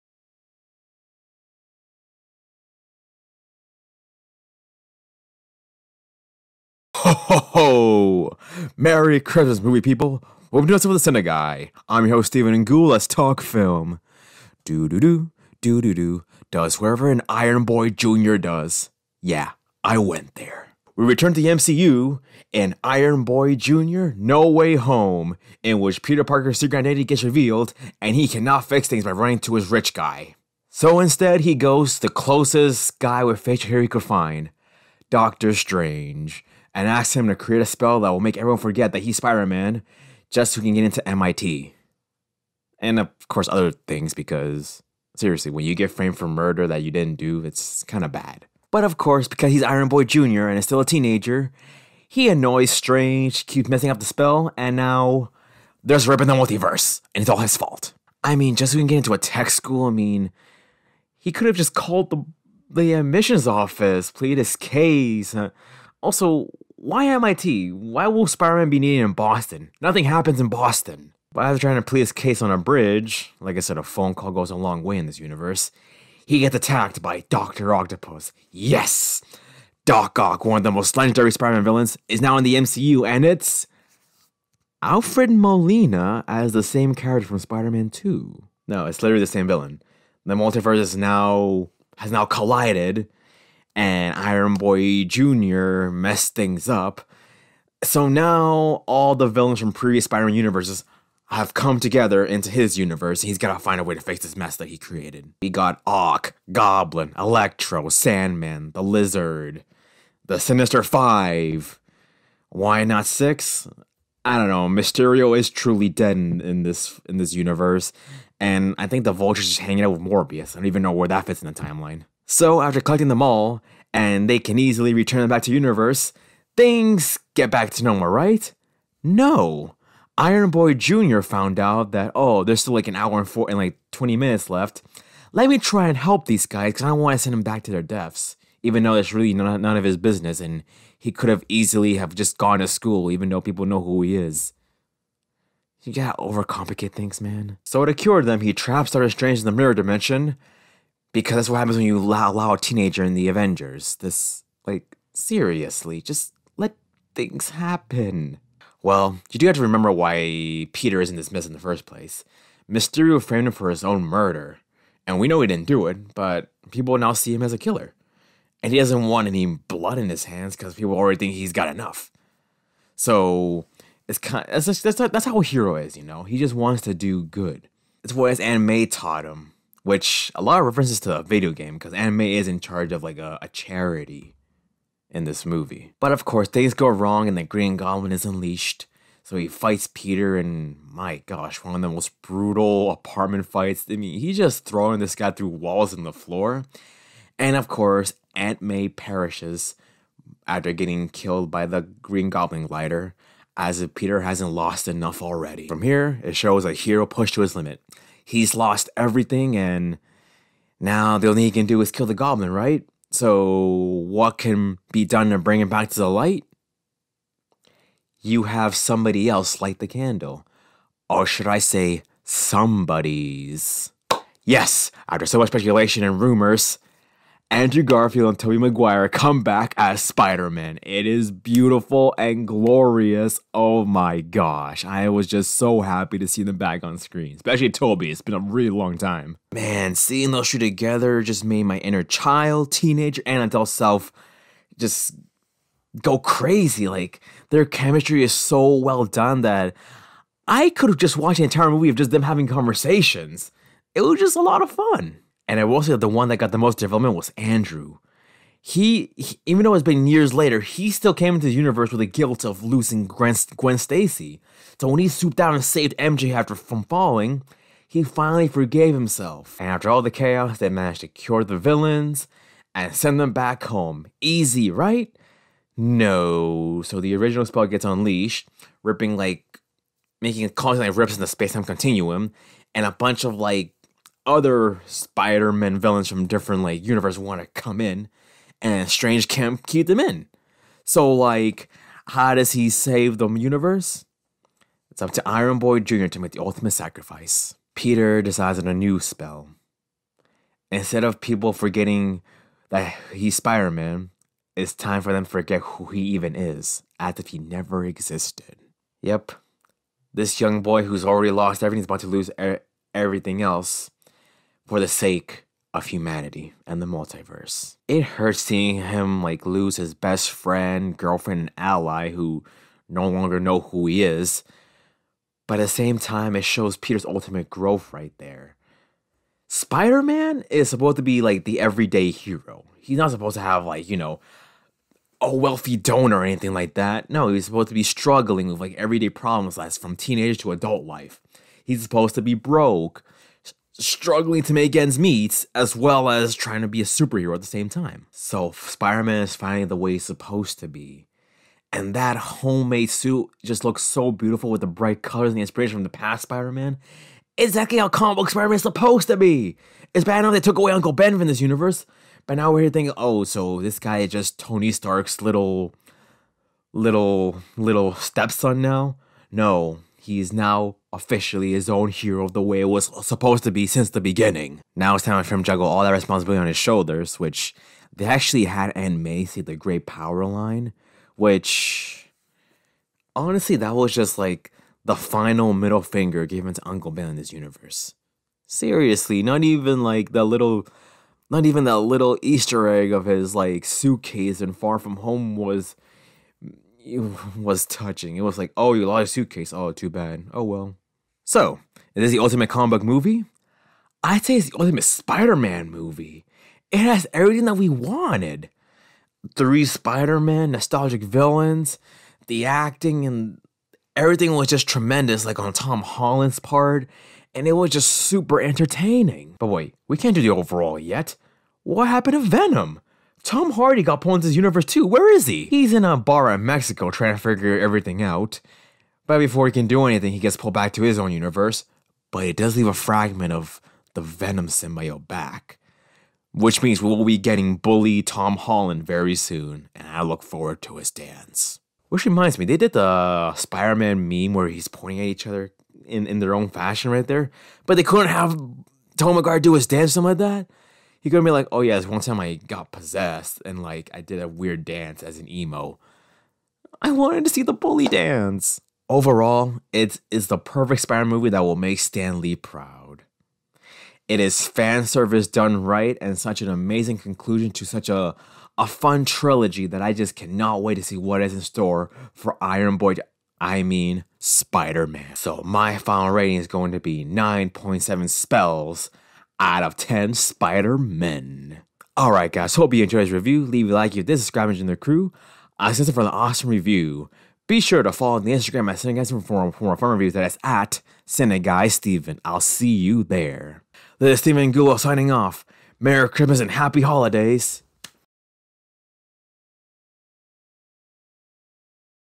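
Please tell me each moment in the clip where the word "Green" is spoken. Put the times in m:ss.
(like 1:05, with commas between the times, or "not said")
3:07, 3:21.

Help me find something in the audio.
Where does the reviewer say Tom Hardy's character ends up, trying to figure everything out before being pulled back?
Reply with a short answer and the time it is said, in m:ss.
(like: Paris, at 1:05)
A bar in Mexico, at 7:05.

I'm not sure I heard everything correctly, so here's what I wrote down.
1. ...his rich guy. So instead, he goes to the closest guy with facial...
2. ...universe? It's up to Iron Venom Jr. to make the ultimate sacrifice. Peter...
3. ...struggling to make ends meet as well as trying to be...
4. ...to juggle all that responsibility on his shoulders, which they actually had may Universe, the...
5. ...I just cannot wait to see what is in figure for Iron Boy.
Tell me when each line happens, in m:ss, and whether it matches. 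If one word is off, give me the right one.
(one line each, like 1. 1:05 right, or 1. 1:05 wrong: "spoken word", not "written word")
1. 0:29 right
2. 4:53 wrong: "Boy", not "Venom"
3. 5:43 right
4. 6:15 wrong: "Macy", not "Universe"
5. 7:49 wrong: "store", not "figure".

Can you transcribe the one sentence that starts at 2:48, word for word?
And he doesn't want any blood in his hands because people already think he's got enough.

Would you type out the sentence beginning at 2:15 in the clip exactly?
Let me try and help these guys because I don't want to send them back to their deaths.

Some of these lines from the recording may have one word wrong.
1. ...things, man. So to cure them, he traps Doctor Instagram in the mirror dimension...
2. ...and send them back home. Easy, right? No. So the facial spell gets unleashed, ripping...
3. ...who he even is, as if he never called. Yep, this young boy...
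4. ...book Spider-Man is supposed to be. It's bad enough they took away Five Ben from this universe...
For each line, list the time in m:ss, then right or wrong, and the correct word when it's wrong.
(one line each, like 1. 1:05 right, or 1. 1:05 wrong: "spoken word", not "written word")
1. 2:26 wrong: "Strange", not "Instagram"
2. 4:32 wrong: "original", not "facial"
3. 5:05 wrong: "existed", not "called"
4. 5:58 wrong: "Uncle", not "Five".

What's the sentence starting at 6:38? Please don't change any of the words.
It was like, oh, you lost your suitcase.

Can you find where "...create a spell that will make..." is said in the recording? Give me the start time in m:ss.
0:37.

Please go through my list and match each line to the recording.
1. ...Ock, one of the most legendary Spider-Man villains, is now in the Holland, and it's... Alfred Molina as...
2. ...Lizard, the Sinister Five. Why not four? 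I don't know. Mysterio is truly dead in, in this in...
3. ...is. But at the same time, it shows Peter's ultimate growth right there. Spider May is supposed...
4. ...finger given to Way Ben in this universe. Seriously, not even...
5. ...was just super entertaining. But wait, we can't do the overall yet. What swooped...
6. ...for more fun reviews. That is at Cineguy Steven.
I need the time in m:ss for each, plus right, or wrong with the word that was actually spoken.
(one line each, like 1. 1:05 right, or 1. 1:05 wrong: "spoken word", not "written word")
1. 1:20 wrong: "MCU", not "Holland"
2. 1:48 wrong: "six", not "four"
3. 5:24 wrong: "Man", not "May"
4. 6:25 wrong: "Uncle", not "Way"
5. 6:57 wrong: "happened", not "swooped"
6. 8:09 right.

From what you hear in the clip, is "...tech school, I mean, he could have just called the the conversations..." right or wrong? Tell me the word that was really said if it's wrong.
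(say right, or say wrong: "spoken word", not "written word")
wrong: "admissions", not "conversations".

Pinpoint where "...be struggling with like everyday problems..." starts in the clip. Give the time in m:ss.
5:37.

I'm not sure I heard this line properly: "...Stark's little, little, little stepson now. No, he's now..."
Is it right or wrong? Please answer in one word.
right.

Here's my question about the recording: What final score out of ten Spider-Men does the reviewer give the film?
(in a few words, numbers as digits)
9.7.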